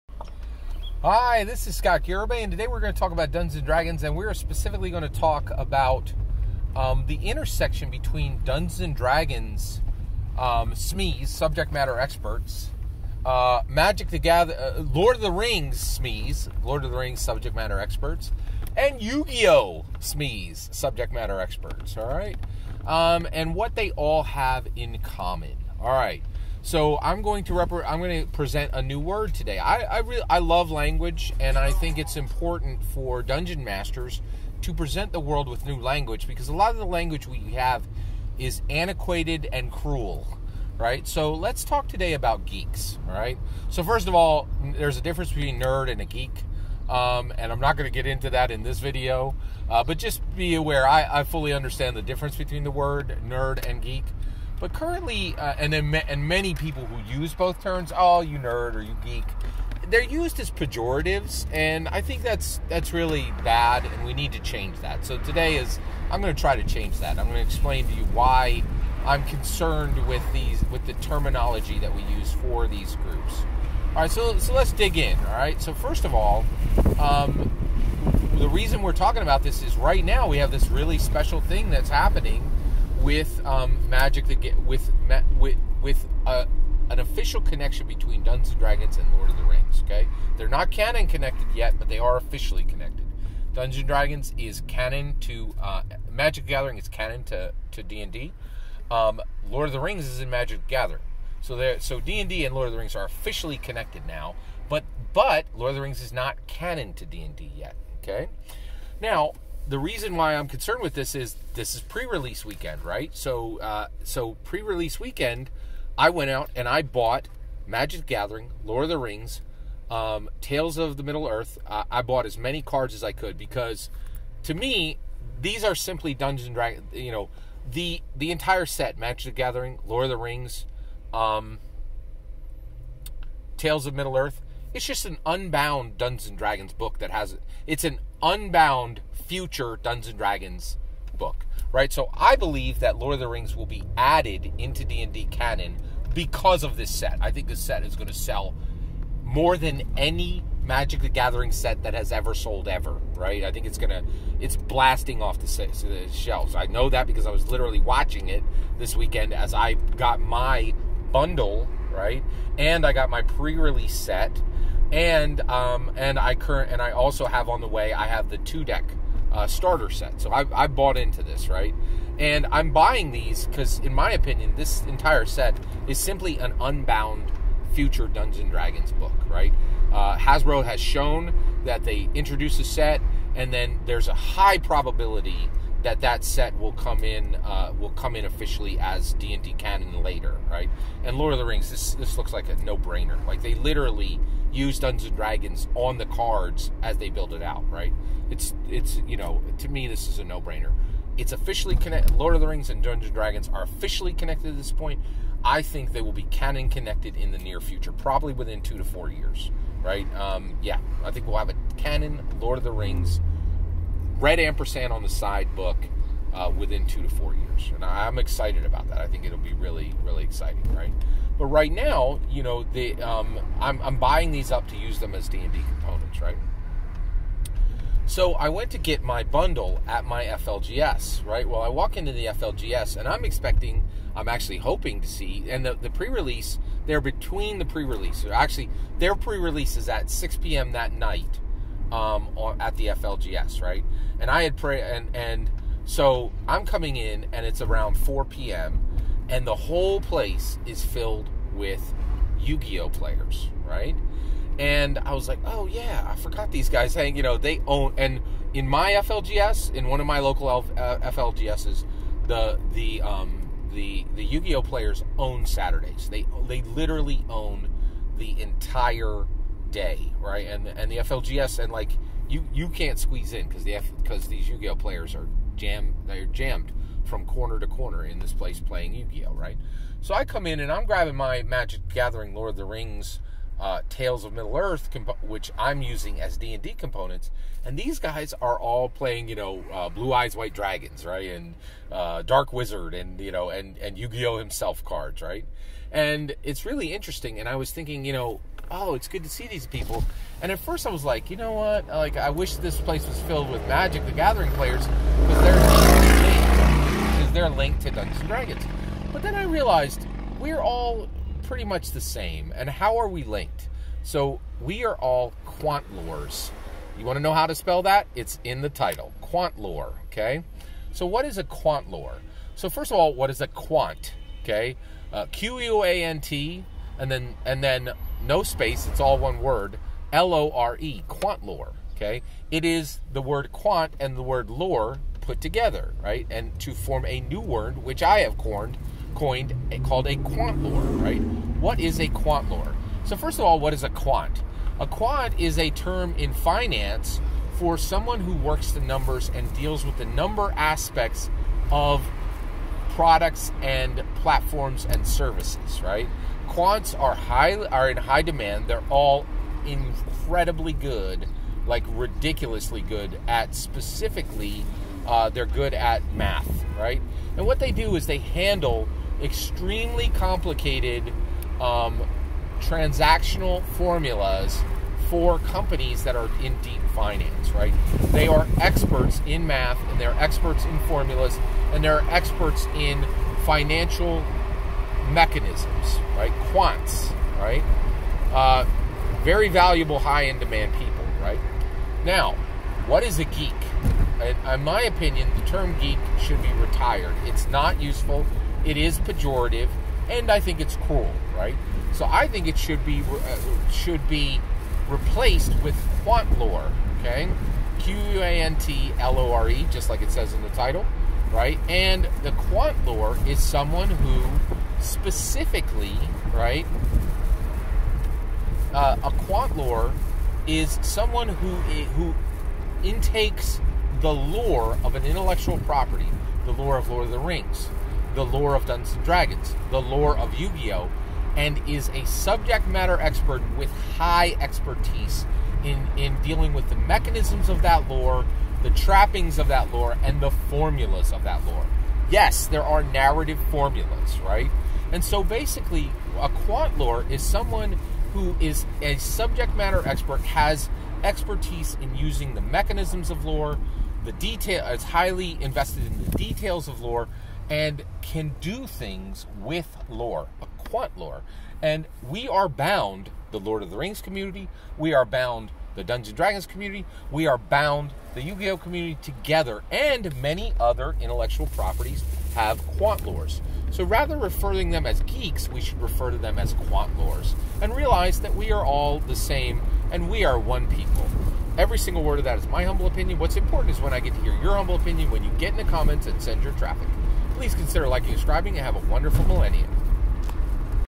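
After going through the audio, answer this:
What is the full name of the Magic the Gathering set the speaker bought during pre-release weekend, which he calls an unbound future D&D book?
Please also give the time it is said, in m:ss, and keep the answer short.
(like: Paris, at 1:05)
Tales of the Middle Earth, at 2:00.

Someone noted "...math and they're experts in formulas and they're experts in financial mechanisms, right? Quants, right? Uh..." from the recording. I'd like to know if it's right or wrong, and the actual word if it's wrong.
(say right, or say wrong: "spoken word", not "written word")
right.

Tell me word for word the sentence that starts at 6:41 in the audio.
So I think it should be uh, should be replaced with quant lore, okay?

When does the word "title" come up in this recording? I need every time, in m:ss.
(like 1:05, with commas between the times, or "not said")
5:18, 6:50.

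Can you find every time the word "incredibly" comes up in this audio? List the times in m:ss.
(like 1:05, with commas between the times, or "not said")
5:59.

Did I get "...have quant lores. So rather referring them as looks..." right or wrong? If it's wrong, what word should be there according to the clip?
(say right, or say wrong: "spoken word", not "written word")
wrong: "geeks", not "looks".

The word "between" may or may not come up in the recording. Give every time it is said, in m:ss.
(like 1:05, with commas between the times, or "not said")
0:07, 0:45, 0:52, 1:27, 3:57.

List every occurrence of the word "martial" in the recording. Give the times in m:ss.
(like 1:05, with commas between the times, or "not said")
not said.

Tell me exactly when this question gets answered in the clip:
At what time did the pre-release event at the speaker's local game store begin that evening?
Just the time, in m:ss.
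4:00.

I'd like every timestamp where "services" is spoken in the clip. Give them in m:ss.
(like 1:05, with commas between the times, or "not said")
5:55.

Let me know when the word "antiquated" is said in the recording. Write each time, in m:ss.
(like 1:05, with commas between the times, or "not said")
0:38.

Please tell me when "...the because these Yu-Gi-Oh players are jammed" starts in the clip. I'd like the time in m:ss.
4:33.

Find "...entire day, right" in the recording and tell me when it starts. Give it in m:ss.
4:28.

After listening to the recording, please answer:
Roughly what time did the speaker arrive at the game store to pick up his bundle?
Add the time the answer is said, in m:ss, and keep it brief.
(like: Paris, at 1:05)
4 p.m., at 4:07.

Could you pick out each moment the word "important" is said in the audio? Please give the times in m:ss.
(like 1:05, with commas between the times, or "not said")
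0:32, 8:03.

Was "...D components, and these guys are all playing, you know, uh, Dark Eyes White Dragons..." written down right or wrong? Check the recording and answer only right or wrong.
wrong.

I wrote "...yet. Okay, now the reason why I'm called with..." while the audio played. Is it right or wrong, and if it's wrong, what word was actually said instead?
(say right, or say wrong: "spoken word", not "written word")
wrong: "concerned", not "called".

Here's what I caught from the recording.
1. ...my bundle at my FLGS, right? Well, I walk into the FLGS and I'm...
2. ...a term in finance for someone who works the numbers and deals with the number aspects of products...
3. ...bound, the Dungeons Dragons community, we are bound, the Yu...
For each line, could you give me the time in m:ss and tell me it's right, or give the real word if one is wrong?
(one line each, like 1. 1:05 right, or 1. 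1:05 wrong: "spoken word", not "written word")
1. 3:49 right
2. 5:45 right
3. 7:45 right.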